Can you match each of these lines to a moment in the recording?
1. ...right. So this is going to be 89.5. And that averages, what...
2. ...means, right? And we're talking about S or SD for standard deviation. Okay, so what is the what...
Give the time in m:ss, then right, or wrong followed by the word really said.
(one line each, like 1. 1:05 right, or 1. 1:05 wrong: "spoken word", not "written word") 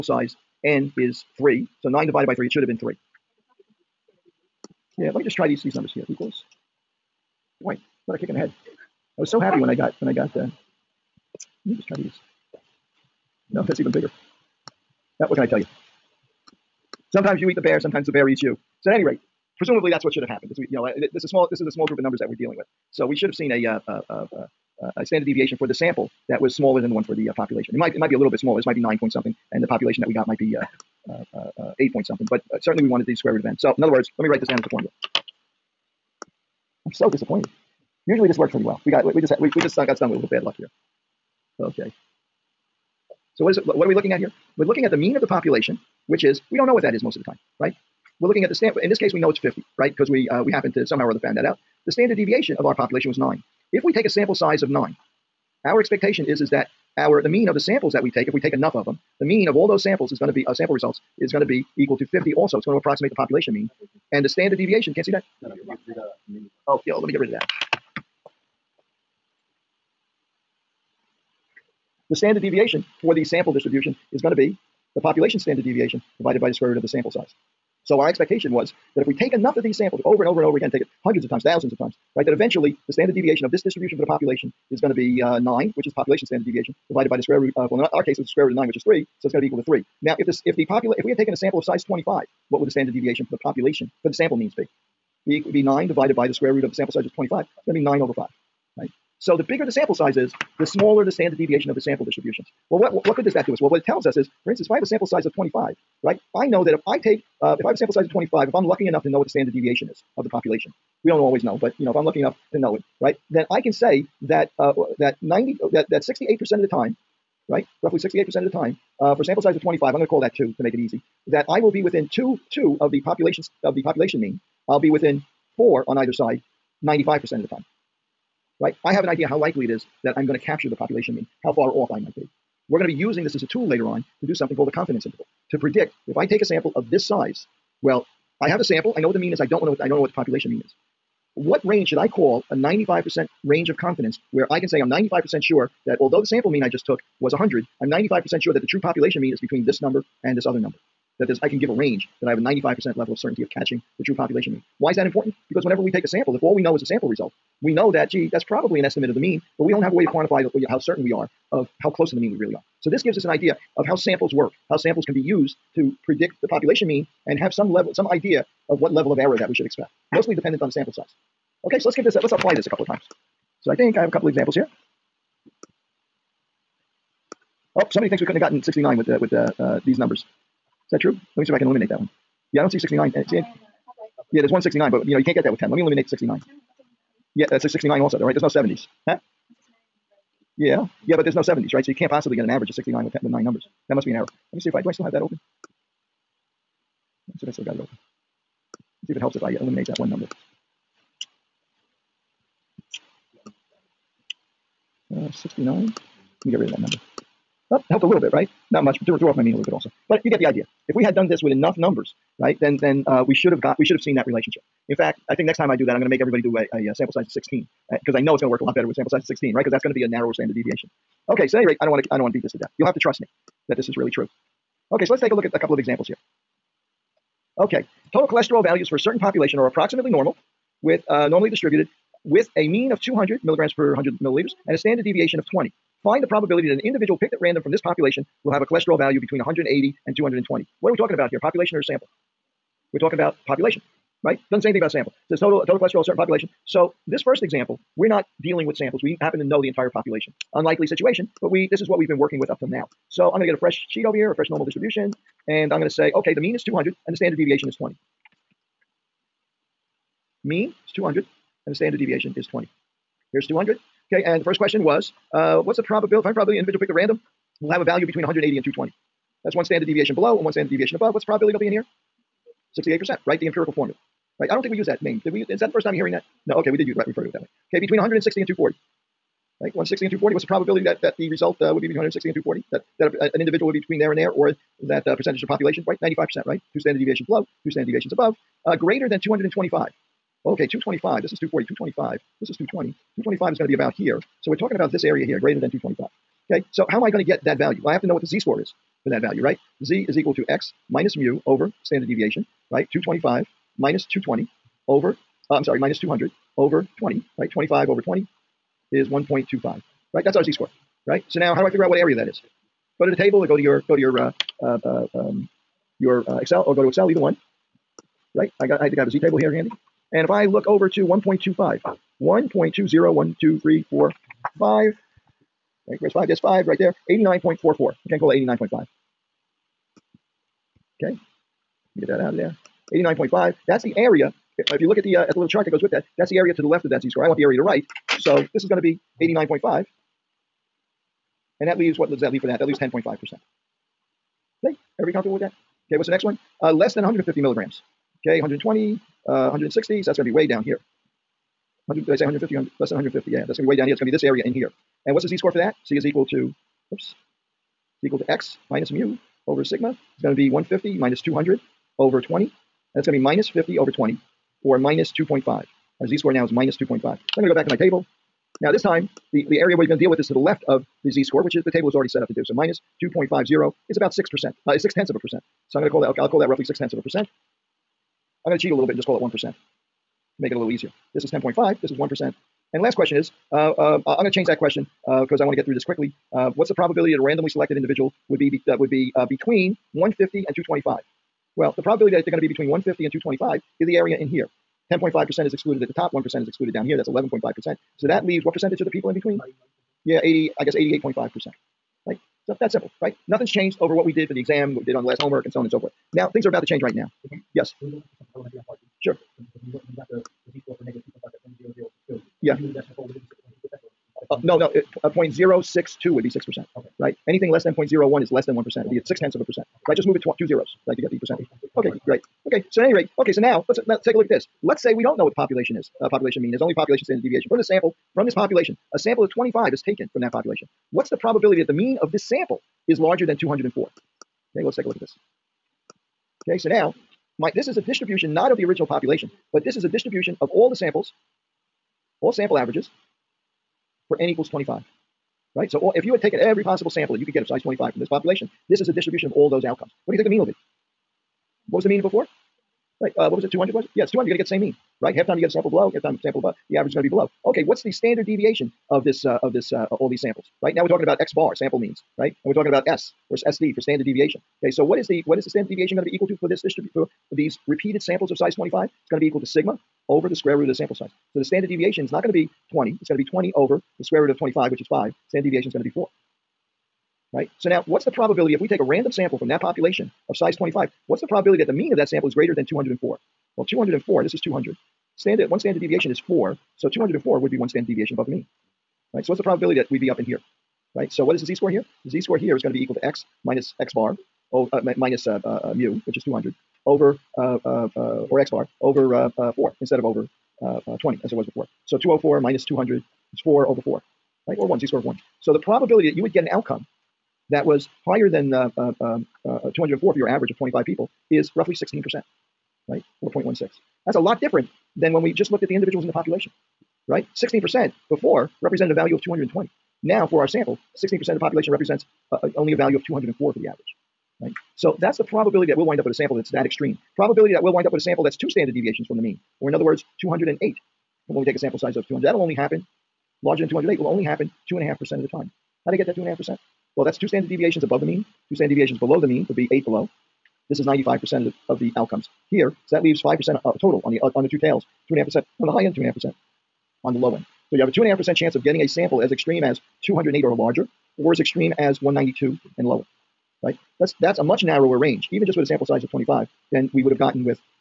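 1. 5:37 wrong: "leaves", not "averages"
2. 7:41 right.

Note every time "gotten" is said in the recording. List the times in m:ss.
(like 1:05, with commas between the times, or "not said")
2:58, 9:17.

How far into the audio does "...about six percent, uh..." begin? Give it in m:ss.
6:13.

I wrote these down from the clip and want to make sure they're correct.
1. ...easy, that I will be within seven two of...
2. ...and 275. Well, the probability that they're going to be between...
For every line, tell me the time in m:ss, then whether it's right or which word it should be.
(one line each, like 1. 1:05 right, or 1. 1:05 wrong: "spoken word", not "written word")
1. 2:00 wrong: "two", not "seven"
2. 6:30 wrong: "225", not "275".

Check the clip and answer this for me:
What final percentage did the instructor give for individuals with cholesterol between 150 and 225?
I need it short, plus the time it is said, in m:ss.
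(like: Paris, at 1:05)
88.5%, at 6:40.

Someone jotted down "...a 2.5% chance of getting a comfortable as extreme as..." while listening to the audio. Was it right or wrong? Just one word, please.
wrong.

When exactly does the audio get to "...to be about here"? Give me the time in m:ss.
4:53.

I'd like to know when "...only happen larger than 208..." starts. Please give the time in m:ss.
8:52.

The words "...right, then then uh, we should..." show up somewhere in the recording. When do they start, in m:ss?
3:32.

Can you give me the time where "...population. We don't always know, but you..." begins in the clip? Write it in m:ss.
1:50.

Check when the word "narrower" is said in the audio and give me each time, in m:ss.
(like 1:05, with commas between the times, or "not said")
3:40, 9:14.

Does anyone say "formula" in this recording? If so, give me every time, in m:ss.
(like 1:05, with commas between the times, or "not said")
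0:34, 4:33.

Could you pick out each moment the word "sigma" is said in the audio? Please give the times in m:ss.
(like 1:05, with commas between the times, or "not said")
5:59, 7:49.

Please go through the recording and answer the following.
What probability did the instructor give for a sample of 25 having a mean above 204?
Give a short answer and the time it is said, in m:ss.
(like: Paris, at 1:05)
16%, at 8:31.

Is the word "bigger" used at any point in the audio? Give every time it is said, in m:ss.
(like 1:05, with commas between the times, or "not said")
0:13, 1:39.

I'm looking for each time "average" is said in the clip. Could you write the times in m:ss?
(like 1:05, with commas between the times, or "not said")
3:12, 7:22, 7:36, 8:30, 8:43.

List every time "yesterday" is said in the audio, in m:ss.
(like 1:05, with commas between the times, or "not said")
not said.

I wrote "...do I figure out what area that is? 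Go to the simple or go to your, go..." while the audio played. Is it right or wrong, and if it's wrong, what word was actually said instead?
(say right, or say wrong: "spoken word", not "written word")
wrong: "table", not "simple".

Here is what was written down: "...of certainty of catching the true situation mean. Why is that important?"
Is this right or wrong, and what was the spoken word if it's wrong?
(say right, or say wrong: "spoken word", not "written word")
wrong: "population", not "situation".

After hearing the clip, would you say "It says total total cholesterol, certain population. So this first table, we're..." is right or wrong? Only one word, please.
wrong.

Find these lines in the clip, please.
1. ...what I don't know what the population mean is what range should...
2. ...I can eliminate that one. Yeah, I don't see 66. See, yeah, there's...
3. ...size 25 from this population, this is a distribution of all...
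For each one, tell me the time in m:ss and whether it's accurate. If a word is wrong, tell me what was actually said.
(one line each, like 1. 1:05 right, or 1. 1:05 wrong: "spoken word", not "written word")
1. 2:19 right
2. 3:01 wrong: "69", not "66"
3. 7:27 right.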